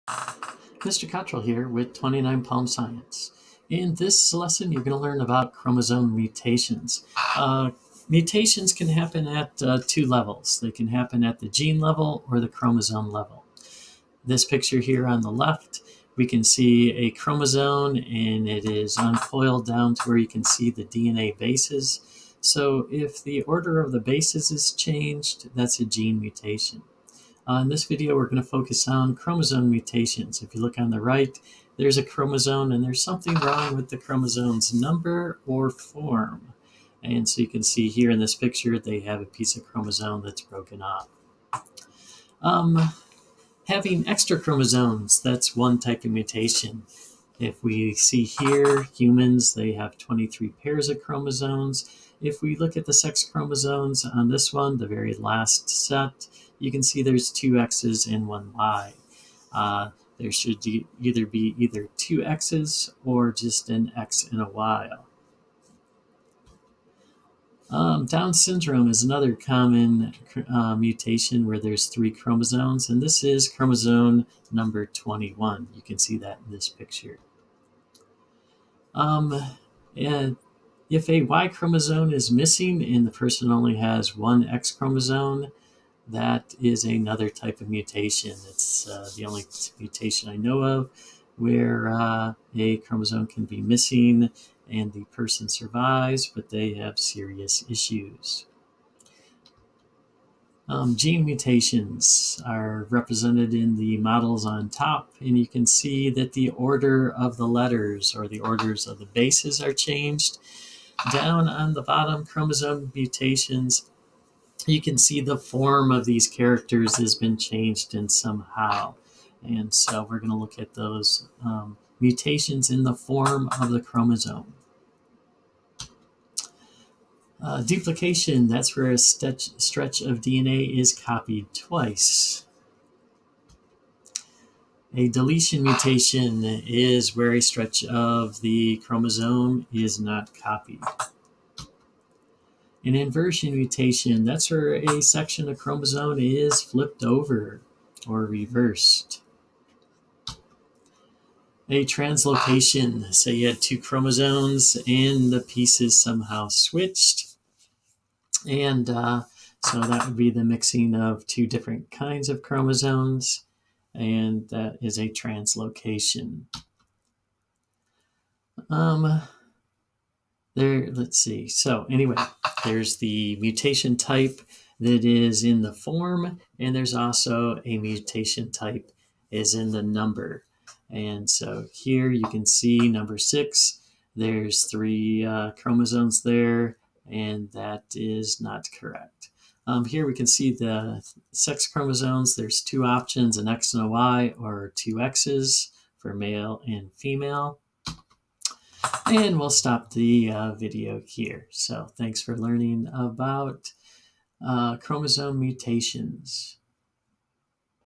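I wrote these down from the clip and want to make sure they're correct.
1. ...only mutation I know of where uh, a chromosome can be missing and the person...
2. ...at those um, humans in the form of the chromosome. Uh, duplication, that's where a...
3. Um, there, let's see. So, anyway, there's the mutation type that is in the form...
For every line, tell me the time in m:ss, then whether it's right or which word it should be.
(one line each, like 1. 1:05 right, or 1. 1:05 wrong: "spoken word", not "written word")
1. 1:29 right
2. 2:00 wrong: "mutations", not "humans"
3. 2:48 right.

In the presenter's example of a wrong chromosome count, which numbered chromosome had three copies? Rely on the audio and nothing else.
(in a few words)
6.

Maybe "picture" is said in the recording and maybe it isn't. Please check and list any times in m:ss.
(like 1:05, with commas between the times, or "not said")
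0:14, 0:38, 1:16.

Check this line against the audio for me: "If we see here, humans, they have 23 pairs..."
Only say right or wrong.
right.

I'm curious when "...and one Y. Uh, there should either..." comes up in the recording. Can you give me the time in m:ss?
0:58.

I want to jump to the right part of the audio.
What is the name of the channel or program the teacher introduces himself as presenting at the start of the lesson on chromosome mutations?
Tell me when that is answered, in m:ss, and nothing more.
0:01.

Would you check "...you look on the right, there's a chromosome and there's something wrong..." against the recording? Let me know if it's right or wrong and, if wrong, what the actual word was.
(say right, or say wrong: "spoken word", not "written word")
right.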